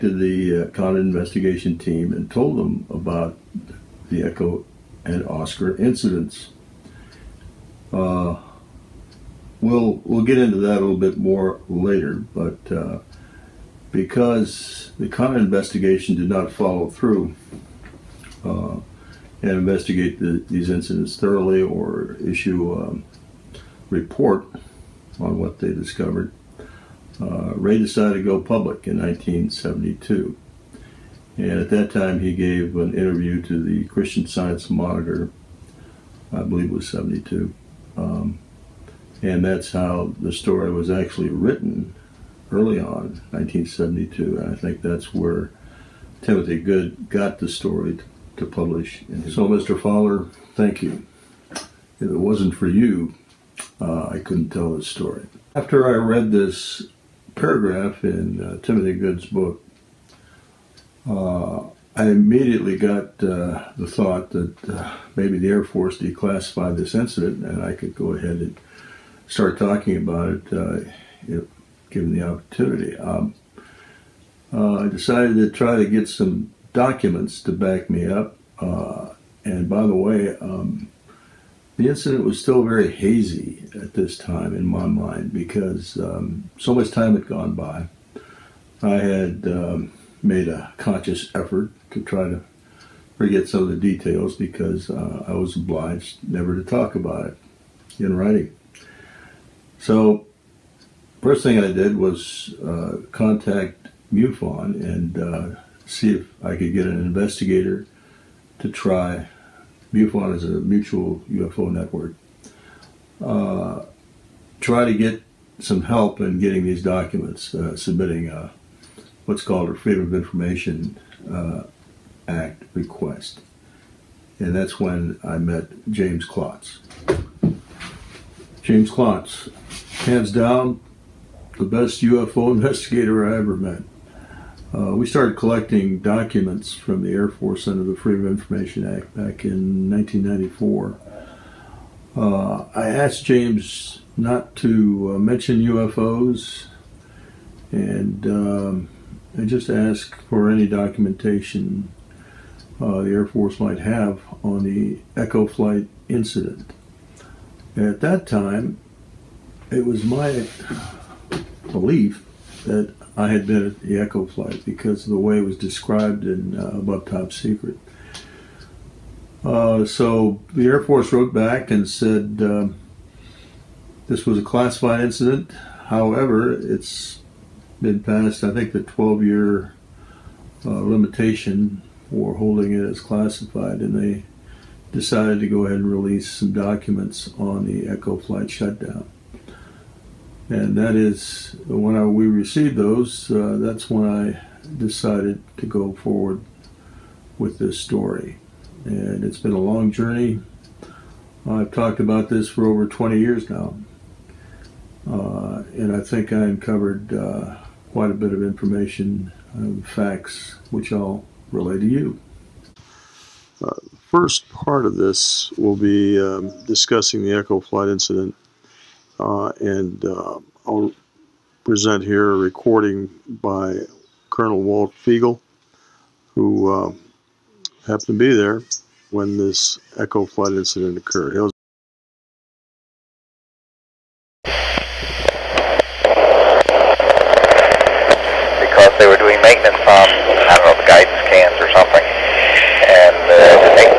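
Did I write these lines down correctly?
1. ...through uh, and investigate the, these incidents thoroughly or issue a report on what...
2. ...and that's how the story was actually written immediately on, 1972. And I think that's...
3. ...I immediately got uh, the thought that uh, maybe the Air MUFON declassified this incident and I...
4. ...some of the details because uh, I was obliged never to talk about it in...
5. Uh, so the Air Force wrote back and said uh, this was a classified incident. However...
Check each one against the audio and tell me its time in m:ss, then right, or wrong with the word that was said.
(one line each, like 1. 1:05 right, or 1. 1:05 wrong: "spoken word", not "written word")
1. 0:16 right
2. 0:39 wrong: "early", not "immediately"
3. 1:01 wrong: "Force", not "MUFON"
4. 1:33 right
5. 2:49 right.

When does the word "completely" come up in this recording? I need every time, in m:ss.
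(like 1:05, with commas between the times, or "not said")
not said.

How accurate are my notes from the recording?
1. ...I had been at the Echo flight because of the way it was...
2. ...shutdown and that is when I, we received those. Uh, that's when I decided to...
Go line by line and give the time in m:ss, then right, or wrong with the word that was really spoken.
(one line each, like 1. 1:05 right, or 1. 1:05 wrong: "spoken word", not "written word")
1. 2:43 right
2. 3:08 right.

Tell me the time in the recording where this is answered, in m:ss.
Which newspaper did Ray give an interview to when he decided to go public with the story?
0:33.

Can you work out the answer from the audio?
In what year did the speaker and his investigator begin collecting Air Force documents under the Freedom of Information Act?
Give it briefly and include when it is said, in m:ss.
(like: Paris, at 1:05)
1994, at 2:19.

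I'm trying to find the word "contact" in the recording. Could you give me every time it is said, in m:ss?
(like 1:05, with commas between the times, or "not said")
1:43.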